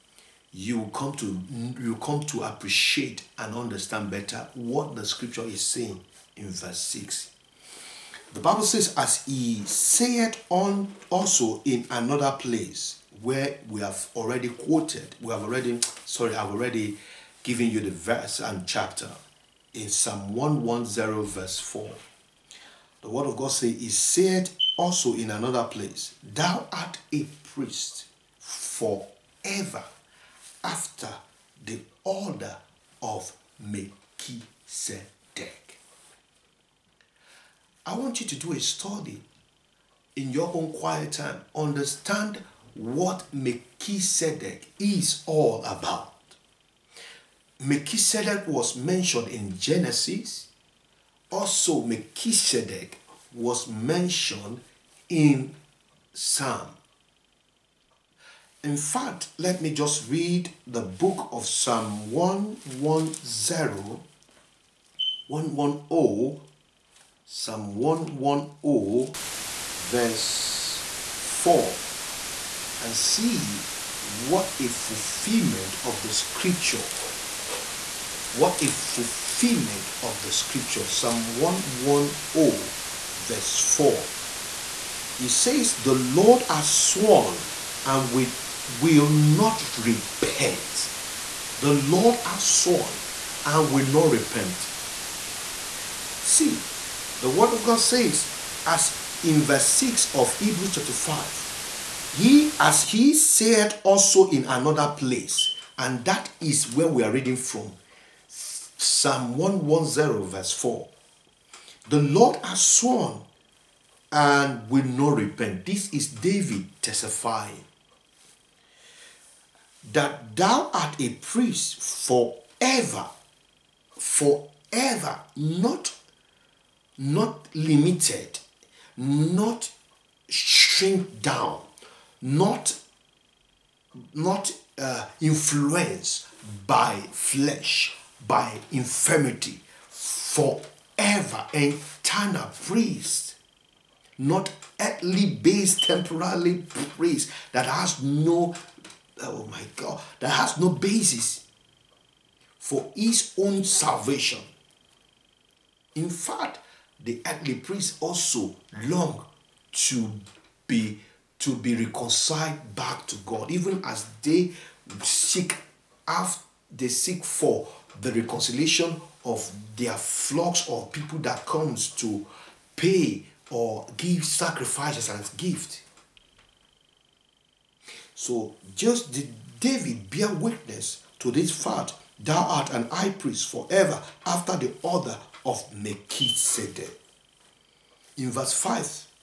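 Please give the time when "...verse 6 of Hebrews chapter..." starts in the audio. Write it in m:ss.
1:39.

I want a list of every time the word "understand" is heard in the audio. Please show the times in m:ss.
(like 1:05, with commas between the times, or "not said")
0:03, 0:41.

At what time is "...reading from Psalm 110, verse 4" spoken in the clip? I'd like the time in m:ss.
1:47.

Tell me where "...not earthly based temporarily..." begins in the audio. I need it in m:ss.
2:24.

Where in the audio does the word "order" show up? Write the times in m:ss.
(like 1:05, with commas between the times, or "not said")
0:32, 3:04.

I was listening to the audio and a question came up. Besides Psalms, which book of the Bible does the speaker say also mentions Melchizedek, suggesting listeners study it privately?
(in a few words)
Genesis.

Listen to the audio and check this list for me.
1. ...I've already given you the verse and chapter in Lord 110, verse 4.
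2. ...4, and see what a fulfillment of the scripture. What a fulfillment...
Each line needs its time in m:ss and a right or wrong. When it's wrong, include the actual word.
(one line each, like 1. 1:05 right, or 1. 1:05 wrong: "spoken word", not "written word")
1. 0:16 wrong: "Psalm", not "Lord"
2. 1:11 right.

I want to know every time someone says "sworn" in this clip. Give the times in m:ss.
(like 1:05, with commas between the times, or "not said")
1:26, 1:32, 1:52.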